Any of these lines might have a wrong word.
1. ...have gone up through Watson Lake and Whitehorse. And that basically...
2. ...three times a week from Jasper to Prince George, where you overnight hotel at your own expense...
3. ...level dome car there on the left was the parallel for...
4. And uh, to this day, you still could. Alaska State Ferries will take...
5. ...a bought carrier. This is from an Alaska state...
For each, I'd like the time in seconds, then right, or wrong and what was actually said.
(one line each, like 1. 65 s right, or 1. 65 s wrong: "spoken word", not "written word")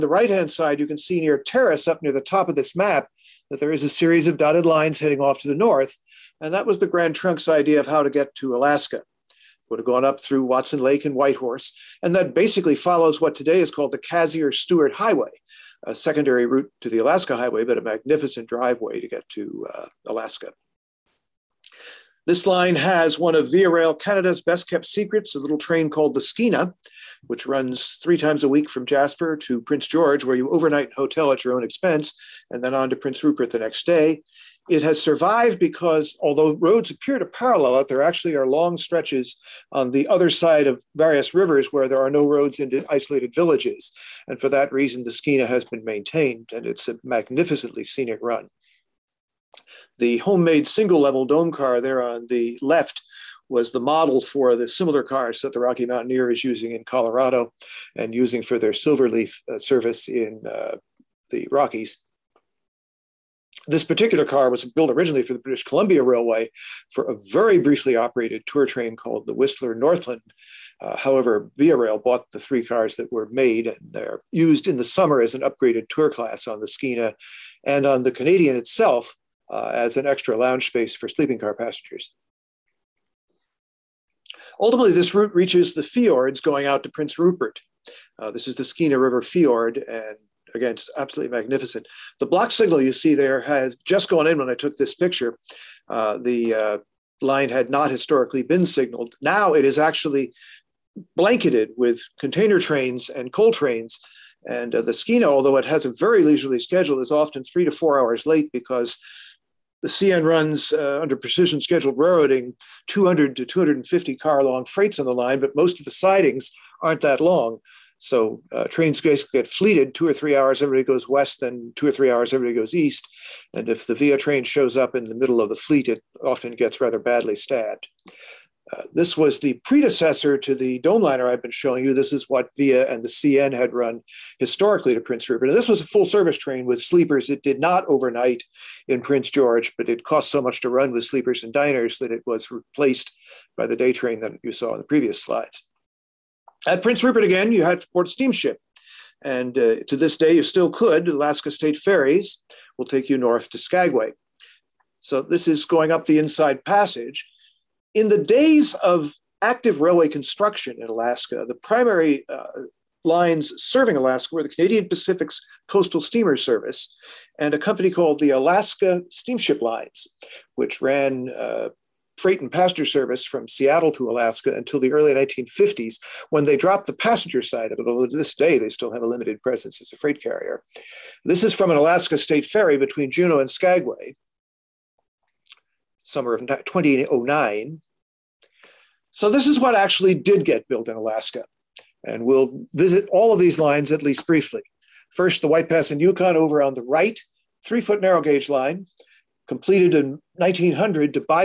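1. 9 s right
2. 28 s right
3. 51 s wrong: "model", not "parallel"
4. 149 s right
5. 179 s wrong: "freight", not "bought".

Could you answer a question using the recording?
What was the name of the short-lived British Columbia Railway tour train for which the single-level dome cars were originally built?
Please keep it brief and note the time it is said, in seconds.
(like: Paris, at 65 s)
Whistler Northwind, at 69 s.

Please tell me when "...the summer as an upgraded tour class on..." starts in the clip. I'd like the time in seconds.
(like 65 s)
74 s.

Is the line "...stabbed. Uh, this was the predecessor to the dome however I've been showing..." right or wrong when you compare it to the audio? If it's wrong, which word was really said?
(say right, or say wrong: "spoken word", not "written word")
wrong: "liner", not "however".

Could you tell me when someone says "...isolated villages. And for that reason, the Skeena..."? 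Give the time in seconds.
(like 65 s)
42 s.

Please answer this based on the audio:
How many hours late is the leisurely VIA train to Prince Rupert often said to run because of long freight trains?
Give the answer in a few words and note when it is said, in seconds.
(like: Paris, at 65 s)
3 to 4 hours, at 107 s.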